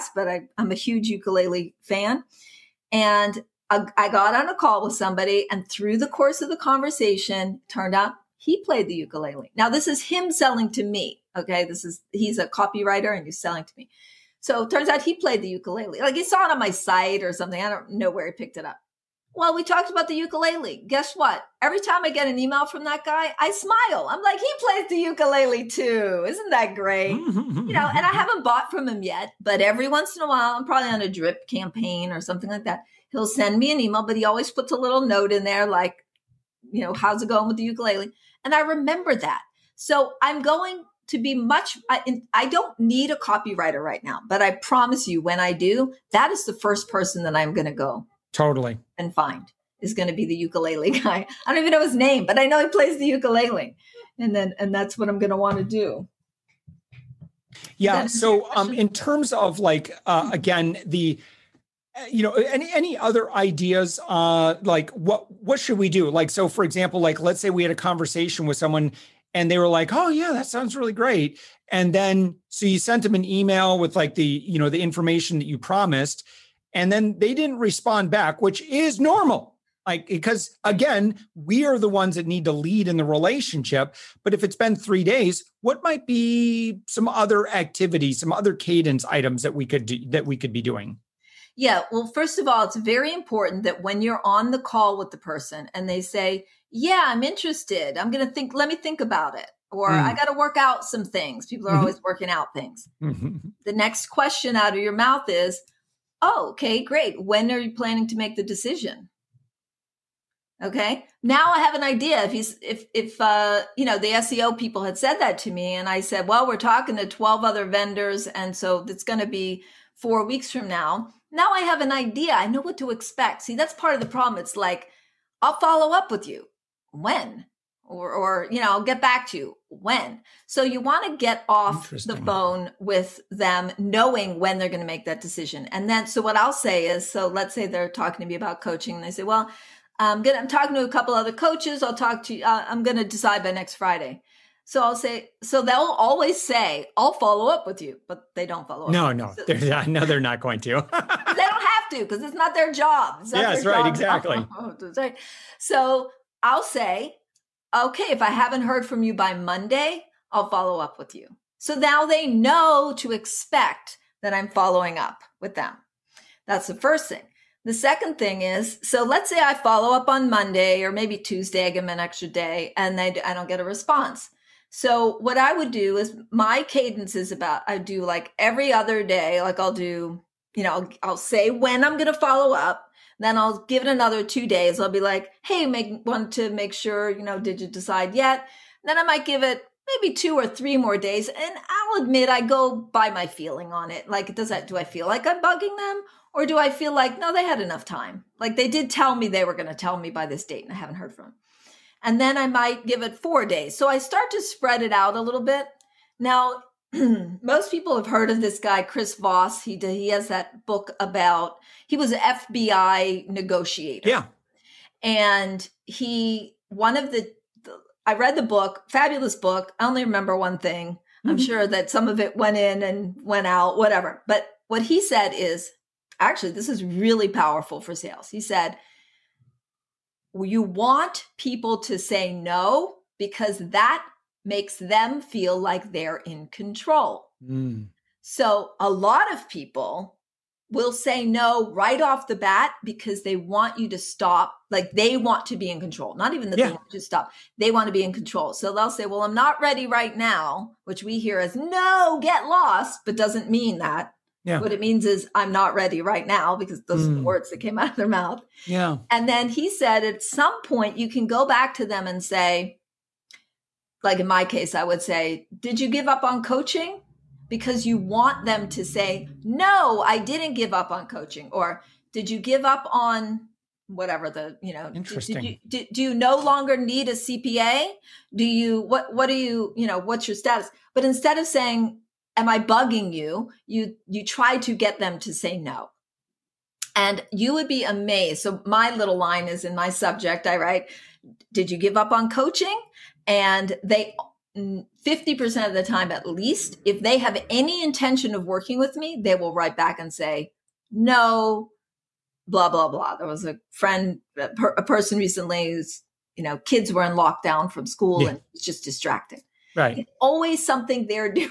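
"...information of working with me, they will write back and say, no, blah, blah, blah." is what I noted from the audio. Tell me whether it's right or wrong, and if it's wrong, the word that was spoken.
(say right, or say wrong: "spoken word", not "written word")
wrong: "intention", not "information".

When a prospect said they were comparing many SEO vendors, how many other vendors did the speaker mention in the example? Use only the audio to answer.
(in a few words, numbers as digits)
12.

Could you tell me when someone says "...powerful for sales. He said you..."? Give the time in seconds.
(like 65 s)
227 s.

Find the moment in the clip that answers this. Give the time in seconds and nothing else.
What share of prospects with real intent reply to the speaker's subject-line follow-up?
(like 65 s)
294 s.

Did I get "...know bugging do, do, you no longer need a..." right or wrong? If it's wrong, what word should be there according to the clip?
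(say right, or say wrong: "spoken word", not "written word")
wrong: "interesting", not "bugging".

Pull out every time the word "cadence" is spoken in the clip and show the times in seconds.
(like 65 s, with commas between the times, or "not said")
88 s, 176 s.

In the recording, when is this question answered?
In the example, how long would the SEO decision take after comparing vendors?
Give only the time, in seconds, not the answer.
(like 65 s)
119 s.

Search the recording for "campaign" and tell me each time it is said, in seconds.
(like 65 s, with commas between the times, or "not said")
31 s.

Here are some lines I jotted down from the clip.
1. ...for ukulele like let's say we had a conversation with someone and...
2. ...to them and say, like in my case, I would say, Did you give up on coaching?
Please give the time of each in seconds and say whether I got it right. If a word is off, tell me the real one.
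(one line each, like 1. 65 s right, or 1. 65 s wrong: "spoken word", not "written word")
1. 66 s wrong: "example", not "ukulele"
2. 261 s right.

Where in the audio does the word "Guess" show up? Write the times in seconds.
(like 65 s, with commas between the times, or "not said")
20 s.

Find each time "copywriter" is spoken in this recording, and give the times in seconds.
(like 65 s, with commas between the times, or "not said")
12 s, 43 s.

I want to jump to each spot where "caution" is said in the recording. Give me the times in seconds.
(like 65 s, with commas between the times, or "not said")
not said.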